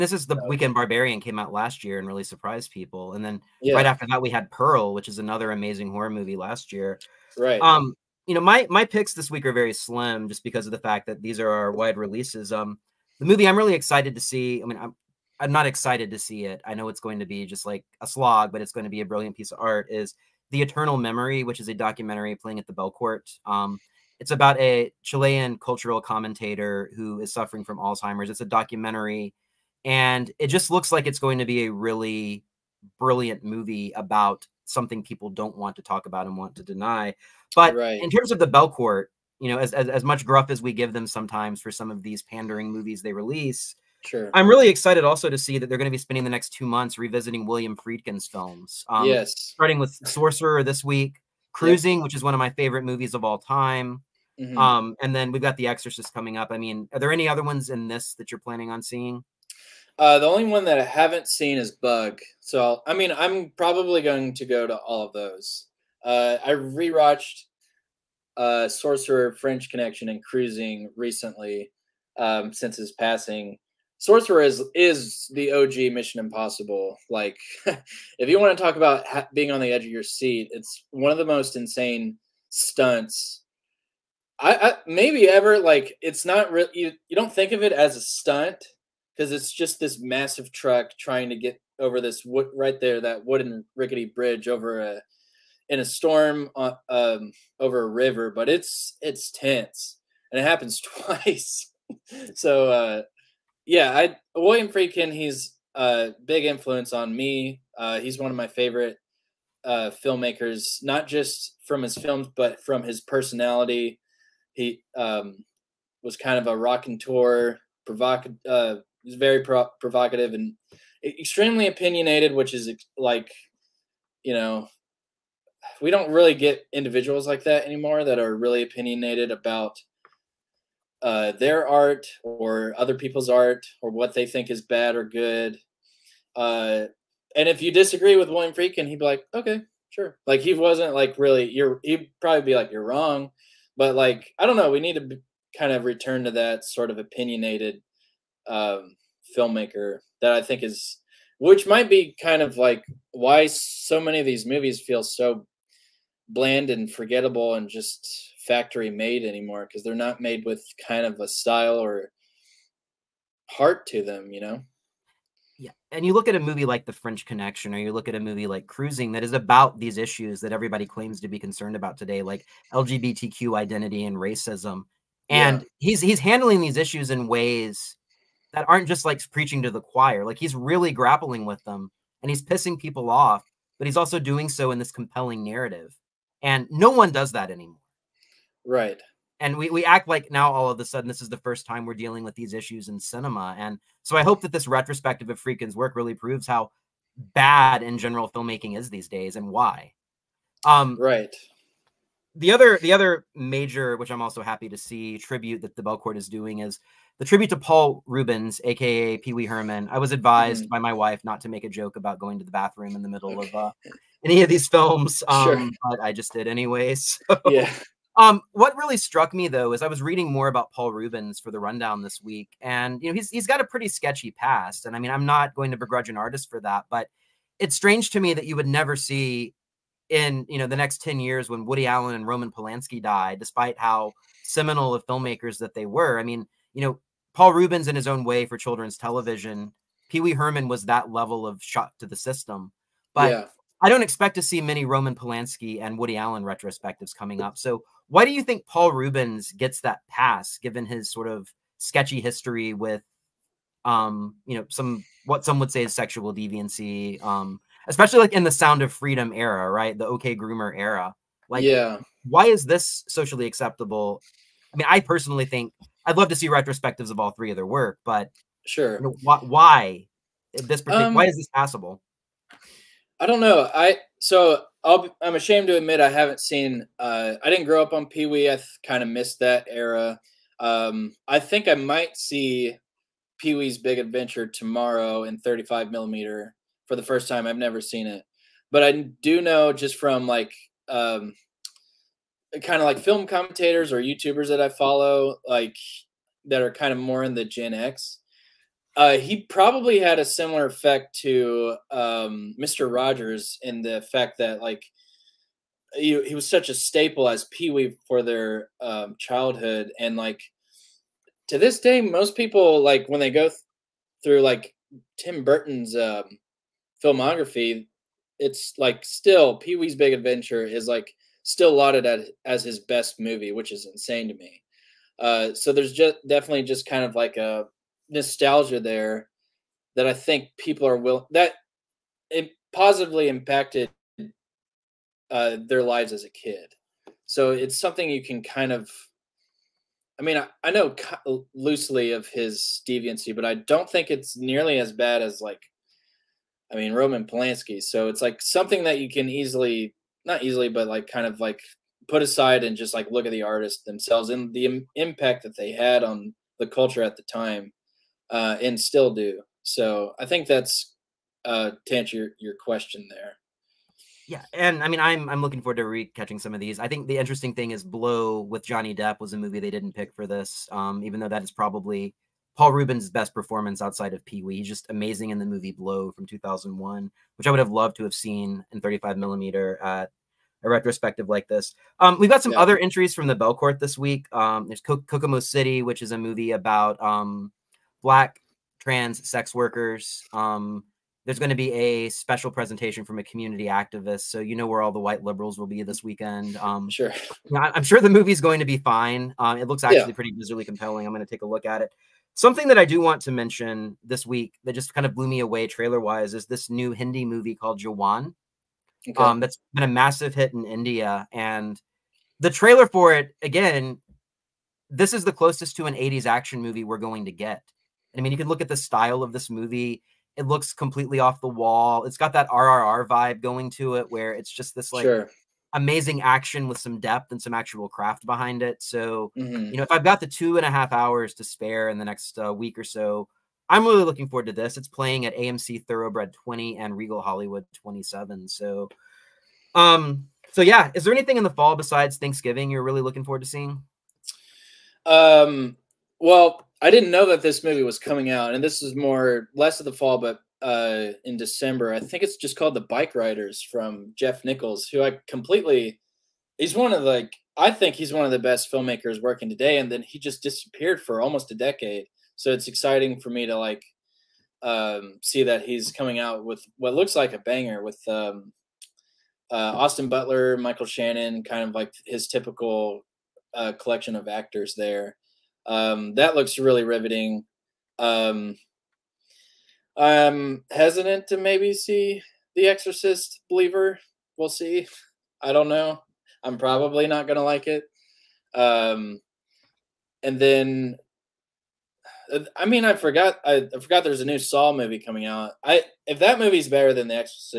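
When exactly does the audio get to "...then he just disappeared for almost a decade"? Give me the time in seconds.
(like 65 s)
459 s.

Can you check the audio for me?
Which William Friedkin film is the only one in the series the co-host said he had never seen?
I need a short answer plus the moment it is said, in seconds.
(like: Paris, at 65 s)
Bug, at 61 s.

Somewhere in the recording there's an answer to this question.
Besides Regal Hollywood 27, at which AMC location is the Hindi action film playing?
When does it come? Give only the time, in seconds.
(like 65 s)
435 s.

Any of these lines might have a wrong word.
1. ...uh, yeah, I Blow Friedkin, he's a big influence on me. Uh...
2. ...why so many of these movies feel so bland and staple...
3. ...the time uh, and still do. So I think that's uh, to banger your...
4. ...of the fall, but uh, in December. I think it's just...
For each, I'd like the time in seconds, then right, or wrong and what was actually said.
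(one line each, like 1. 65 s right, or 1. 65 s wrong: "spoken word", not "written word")
1. 102 s wrong: "William", not "Blow"
2. 153 s wrong: "forgettable", not "staple"
3. 357 s wrong: "answer", not "banger"
4. 449 s right.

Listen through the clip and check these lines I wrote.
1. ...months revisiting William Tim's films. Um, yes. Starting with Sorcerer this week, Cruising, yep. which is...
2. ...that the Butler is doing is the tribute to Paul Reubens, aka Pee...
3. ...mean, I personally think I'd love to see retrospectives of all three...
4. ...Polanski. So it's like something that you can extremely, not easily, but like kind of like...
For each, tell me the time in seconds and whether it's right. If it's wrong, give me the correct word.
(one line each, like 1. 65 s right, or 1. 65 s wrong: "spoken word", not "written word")
1. 46 s wrong: "Friedkin", not "Tim"
2. 205 s wrong: "Belcourt", not "Butler"
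3. 264 s right
4. 347 s wrong: "easily", not "extremely".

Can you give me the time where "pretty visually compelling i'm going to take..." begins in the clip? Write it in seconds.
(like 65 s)
400 s.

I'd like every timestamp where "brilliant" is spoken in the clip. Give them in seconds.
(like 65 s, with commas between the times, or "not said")
19 s, 32 s.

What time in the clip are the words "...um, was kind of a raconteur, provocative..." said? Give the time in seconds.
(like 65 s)
114 s.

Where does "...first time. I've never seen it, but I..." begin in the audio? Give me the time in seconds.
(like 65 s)
287 s.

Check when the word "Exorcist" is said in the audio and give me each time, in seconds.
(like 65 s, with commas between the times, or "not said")
55 s, 482 s.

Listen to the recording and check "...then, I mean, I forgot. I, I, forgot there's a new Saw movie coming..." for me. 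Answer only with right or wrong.
right.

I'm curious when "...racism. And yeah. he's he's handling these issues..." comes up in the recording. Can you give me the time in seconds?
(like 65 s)
174 s.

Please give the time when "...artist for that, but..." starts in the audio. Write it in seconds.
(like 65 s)
226 s.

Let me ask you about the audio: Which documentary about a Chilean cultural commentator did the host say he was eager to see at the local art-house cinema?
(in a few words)
The Eternal Memory.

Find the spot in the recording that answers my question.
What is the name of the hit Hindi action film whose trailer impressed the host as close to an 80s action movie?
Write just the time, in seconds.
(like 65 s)
407 s.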